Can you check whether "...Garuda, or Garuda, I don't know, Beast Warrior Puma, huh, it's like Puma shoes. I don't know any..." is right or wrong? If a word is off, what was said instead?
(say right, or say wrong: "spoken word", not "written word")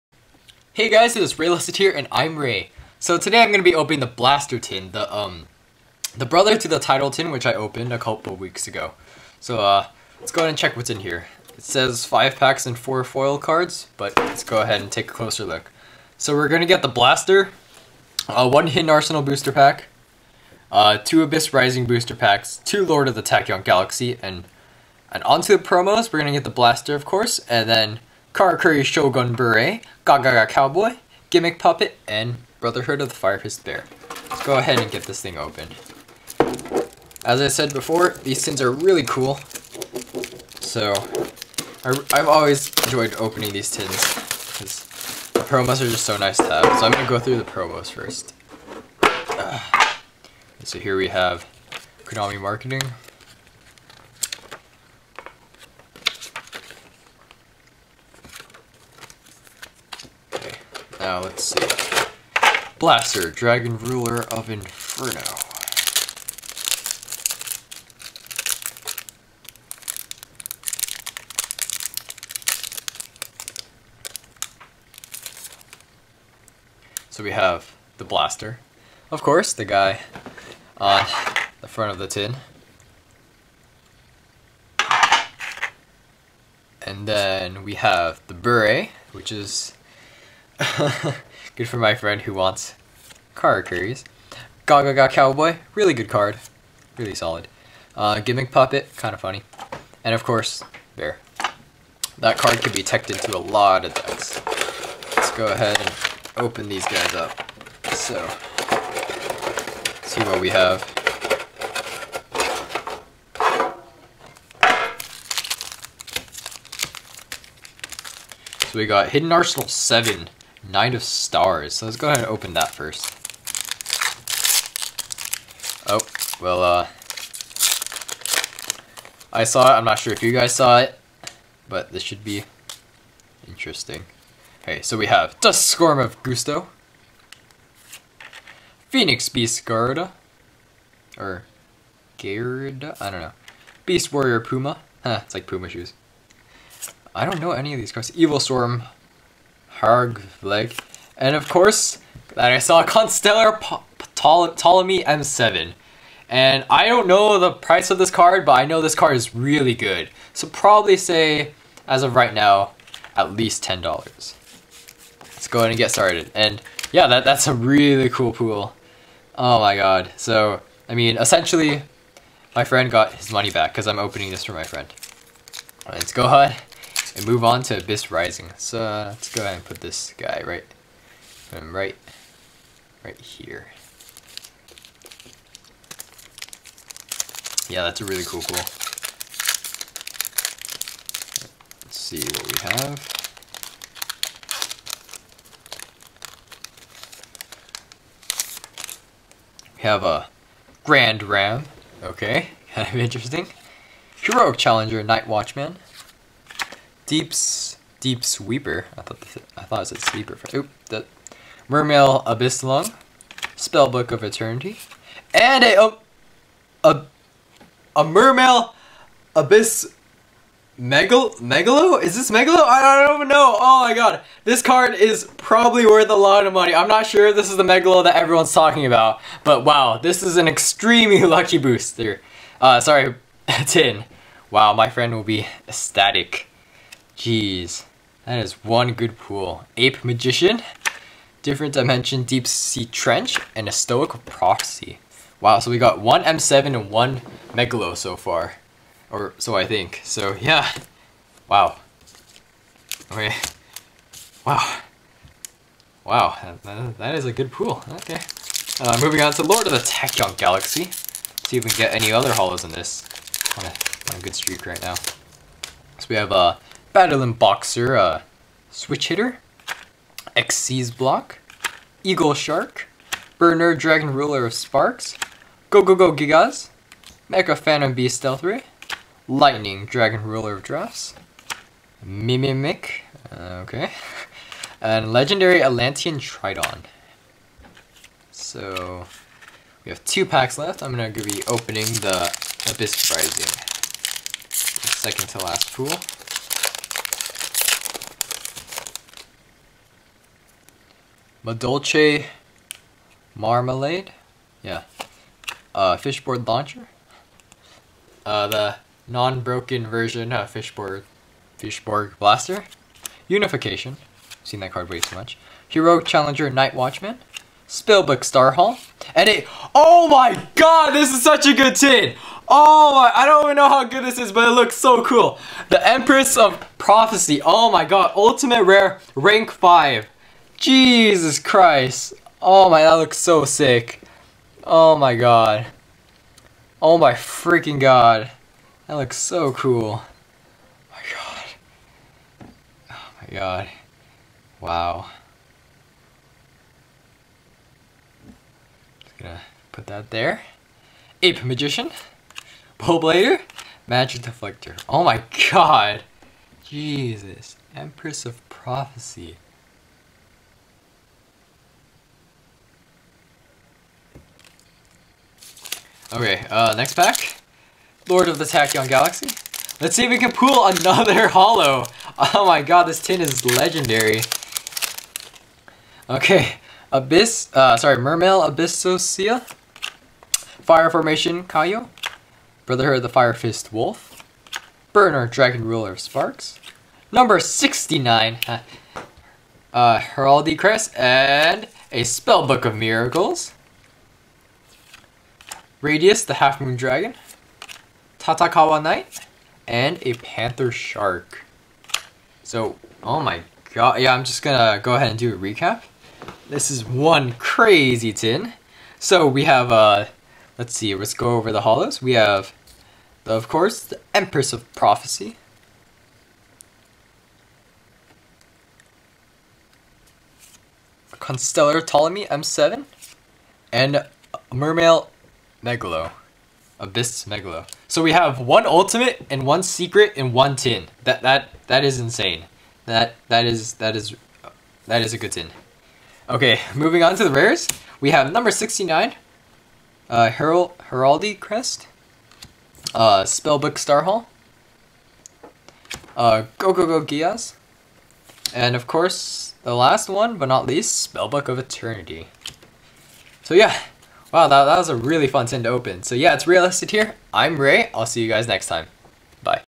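right.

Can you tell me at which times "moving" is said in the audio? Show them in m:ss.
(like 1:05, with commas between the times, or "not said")
4:18, 7:16.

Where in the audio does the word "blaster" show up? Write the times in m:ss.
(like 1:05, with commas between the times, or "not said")
0:04, 0:16, 0:26, 1:02, 1:18, 5:12.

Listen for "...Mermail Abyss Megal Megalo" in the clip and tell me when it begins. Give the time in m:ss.
3:38.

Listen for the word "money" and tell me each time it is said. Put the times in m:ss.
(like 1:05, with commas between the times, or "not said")
2:53, 3:46.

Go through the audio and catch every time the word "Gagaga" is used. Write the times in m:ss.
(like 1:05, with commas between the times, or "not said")
0:30, 1:34.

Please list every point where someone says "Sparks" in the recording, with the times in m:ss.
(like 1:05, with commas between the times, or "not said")
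4:34, 6:26.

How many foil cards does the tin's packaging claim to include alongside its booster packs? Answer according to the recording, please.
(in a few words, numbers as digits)
4.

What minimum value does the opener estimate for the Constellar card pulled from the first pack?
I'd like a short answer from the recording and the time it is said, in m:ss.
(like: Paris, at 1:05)
$10, at 2:43.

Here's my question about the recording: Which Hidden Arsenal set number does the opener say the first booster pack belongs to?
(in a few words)
7.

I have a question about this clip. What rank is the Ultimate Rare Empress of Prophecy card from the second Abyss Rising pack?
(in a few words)
Rank 5.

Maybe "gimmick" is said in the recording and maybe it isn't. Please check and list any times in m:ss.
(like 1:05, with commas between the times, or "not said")
0:31, 1:38.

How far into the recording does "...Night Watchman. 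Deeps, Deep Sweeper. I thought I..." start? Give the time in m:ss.
3:25.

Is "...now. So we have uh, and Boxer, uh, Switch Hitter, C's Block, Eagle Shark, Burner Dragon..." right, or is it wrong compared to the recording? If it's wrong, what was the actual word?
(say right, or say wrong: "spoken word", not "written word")
right.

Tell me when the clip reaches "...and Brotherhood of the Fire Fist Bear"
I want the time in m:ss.
0:32.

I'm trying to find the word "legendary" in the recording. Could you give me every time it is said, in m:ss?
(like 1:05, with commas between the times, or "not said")
4:45, 6:13.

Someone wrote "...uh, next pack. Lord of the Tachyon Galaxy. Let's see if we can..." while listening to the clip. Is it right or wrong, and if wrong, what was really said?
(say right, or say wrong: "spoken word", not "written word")
right.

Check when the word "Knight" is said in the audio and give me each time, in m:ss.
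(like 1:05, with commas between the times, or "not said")
2:00, 6:38.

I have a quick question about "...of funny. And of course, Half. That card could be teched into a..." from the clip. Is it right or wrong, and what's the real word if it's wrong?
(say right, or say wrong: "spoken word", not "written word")
wrong: "Bear", not "Half".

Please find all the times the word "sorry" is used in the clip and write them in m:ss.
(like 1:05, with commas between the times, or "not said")
3:52, 6:17.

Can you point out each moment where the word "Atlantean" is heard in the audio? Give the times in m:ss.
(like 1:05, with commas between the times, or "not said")
4:45.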